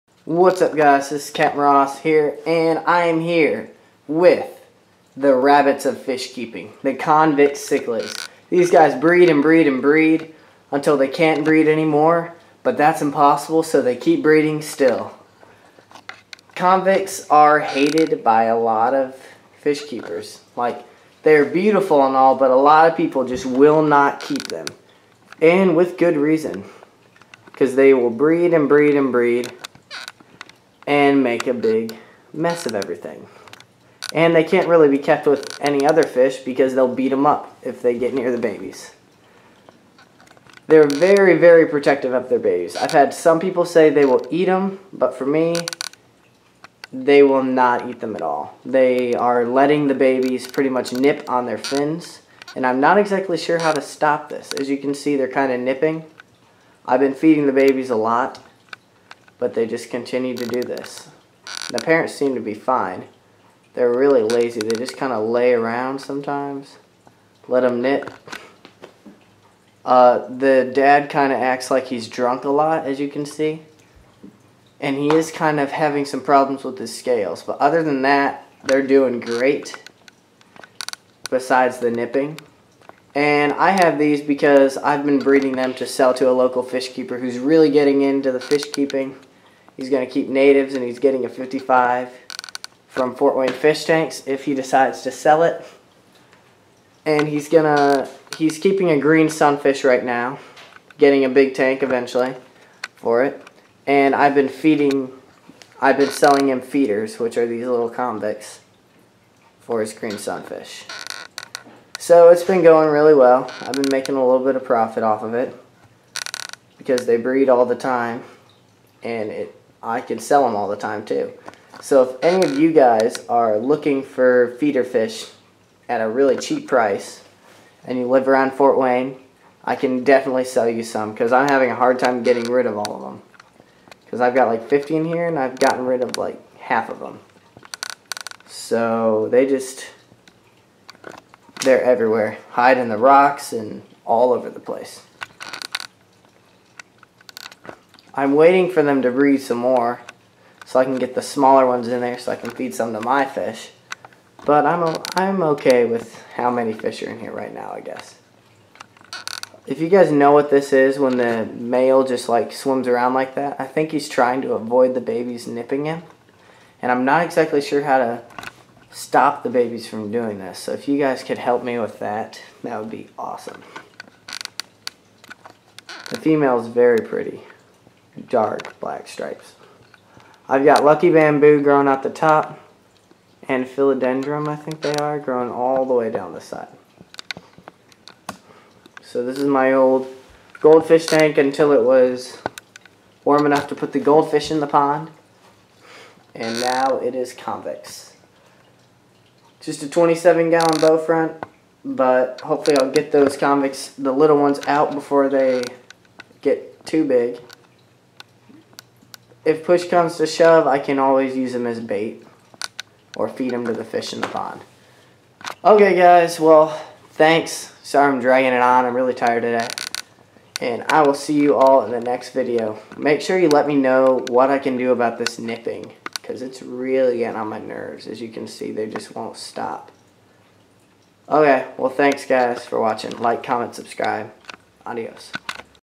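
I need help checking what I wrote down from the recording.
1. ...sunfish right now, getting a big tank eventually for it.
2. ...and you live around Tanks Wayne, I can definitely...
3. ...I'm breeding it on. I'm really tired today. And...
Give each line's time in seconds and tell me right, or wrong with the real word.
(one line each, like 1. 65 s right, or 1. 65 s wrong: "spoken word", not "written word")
1. 99 s right
2. 127 s wrong: "Fort", not "Tanks"
3. 218 s wrong: "dragging", not "breeding".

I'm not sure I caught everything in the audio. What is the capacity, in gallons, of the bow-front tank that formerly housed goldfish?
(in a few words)
27.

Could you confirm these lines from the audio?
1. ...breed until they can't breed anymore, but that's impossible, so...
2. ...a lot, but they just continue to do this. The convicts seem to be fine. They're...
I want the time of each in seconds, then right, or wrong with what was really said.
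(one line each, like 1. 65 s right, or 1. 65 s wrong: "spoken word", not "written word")
1. 9 s right
2. 57 s wrong: "parents", not "convicts".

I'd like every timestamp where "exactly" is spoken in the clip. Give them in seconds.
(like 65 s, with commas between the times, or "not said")
52 s, 167 s.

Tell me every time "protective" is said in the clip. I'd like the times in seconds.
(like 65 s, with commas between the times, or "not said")
41 s.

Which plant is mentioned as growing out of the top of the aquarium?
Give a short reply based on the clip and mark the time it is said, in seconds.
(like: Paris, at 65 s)
Lucky Bamboo, at 180 s.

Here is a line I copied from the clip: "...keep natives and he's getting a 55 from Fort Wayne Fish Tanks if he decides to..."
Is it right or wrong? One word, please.
right.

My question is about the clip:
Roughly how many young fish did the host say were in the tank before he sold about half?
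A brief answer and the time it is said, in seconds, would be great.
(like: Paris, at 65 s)
50, at 134 s.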